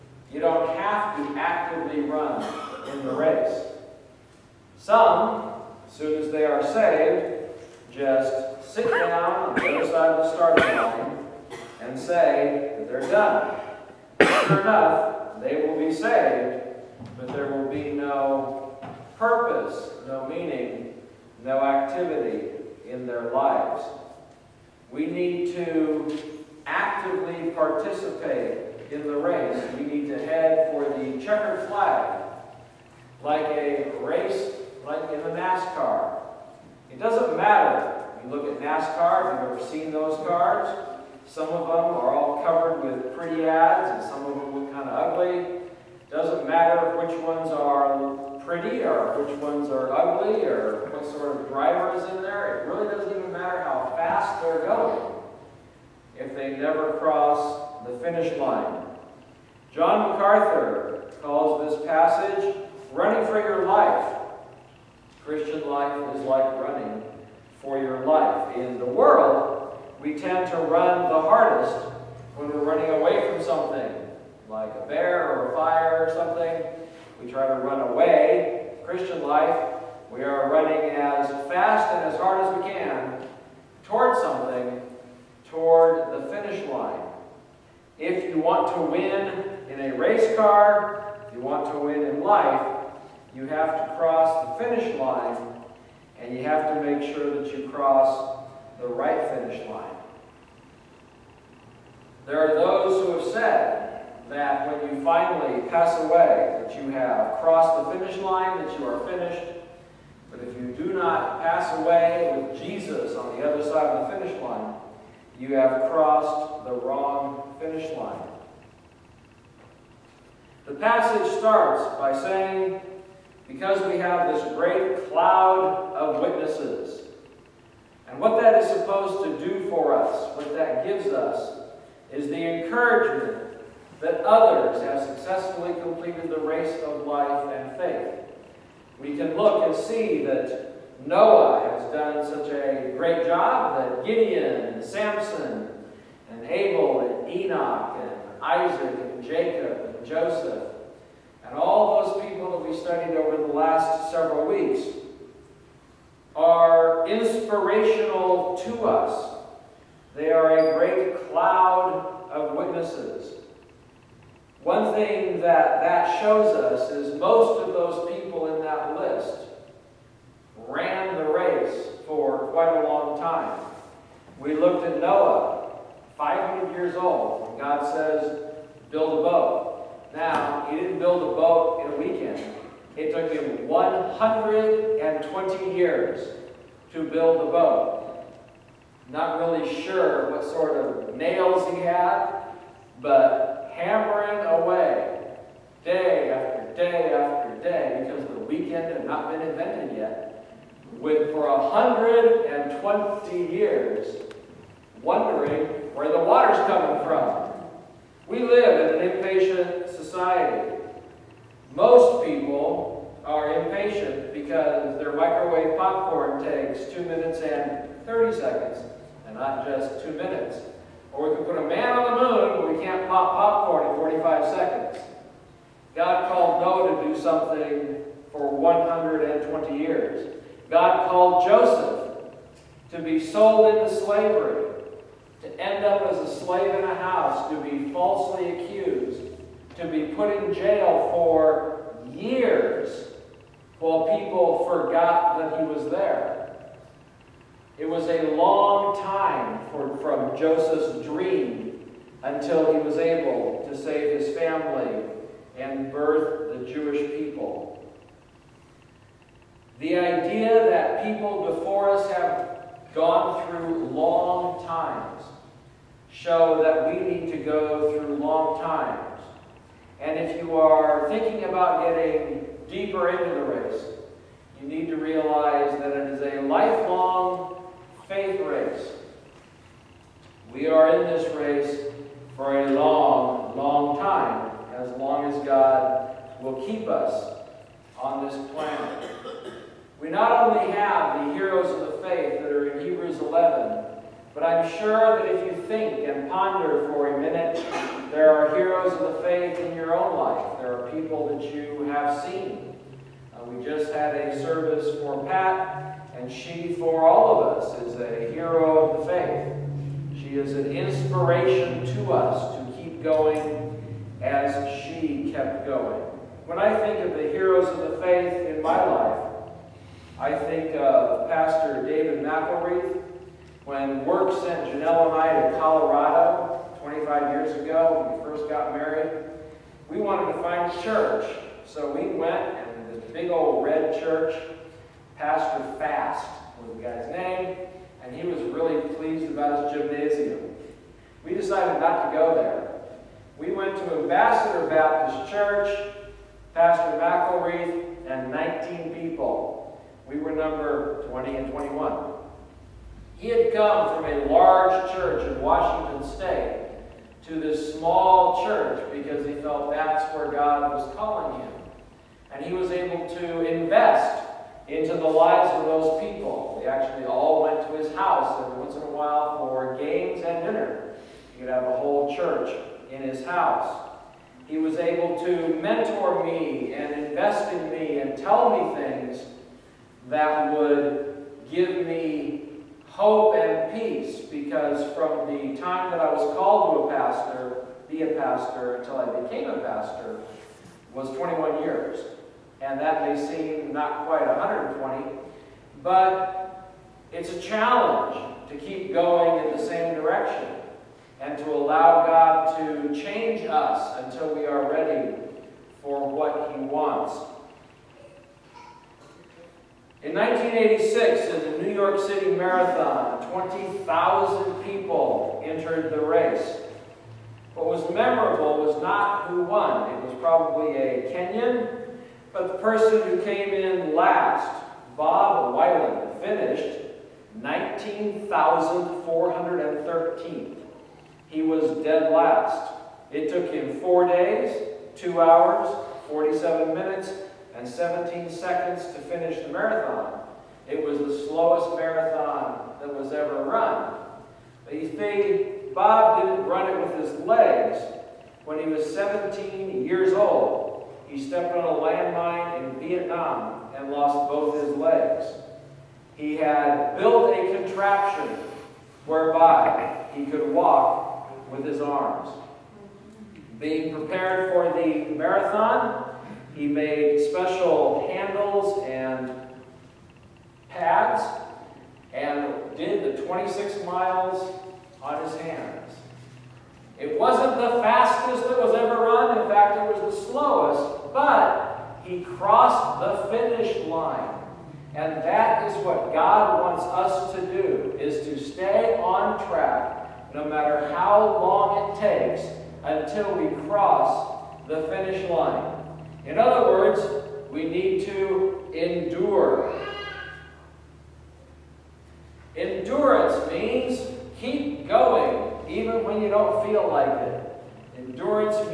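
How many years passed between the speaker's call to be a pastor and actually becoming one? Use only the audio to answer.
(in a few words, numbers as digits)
21.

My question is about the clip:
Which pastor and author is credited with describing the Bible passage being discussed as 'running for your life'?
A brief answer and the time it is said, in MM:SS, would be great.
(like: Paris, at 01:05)
John MacArthur, at 00:59.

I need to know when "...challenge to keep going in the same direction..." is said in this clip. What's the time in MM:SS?
06:37.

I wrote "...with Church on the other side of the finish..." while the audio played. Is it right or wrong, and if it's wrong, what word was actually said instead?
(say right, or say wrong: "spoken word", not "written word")
wrong: "Jesus", not "Church".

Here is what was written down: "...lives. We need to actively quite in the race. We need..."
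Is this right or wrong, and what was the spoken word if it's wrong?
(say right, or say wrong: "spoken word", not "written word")
wrong: "participate", not "quite".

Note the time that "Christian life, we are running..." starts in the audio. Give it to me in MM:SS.
01:18.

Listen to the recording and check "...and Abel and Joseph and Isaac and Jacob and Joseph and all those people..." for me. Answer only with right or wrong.
wrong.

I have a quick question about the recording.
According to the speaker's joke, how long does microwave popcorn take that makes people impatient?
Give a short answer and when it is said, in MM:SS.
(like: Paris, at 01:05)
2 minutes and 30 seconds, at 03:36.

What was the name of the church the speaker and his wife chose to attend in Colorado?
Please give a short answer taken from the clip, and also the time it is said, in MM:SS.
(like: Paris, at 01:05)
Ambassador Baptist Church, at 05:43.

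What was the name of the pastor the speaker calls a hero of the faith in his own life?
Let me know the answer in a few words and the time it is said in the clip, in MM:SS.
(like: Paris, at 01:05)
David McElreath, at 05:21.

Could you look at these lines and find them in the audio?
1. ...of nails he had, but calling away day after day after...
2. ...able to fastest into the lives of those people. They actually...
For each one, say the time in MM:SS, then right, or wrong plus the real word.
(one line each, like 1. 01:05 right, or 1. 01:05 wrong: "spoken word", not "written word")
1. 03:10 wrong: "hammering", not "calling"
2. 06:02 wrong: "invest", not "fastest".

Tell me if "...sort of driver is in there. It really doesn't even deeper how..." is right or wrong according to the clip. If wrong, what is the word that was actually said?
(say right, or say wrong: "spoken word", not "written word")
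wrong: "matter", not "deeper".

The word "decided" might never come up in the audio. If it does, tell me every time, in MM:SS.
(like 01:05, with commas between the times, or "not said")
05:41.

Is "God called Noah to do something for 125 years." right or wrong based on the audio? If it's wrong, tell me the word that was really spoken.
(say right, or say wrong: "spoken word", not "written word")
wrong: "120", not "125".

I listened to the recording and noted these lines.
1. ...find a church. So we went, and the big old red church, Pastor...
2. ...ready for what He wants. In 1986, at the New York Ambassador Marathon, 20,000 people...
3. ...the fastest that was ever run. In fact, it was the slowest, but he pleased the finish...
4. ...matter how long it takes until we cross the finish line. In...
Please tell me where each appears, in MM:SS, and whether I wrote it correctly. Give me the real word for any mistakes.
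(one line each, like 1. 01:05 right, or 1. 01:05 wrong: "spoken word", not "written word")
1. 05:30 right
2. 06:44 wrong: "City", not "Ambassador"
3. 07:57 wrong: "crossed", not "pleased"
4. 08:10 right.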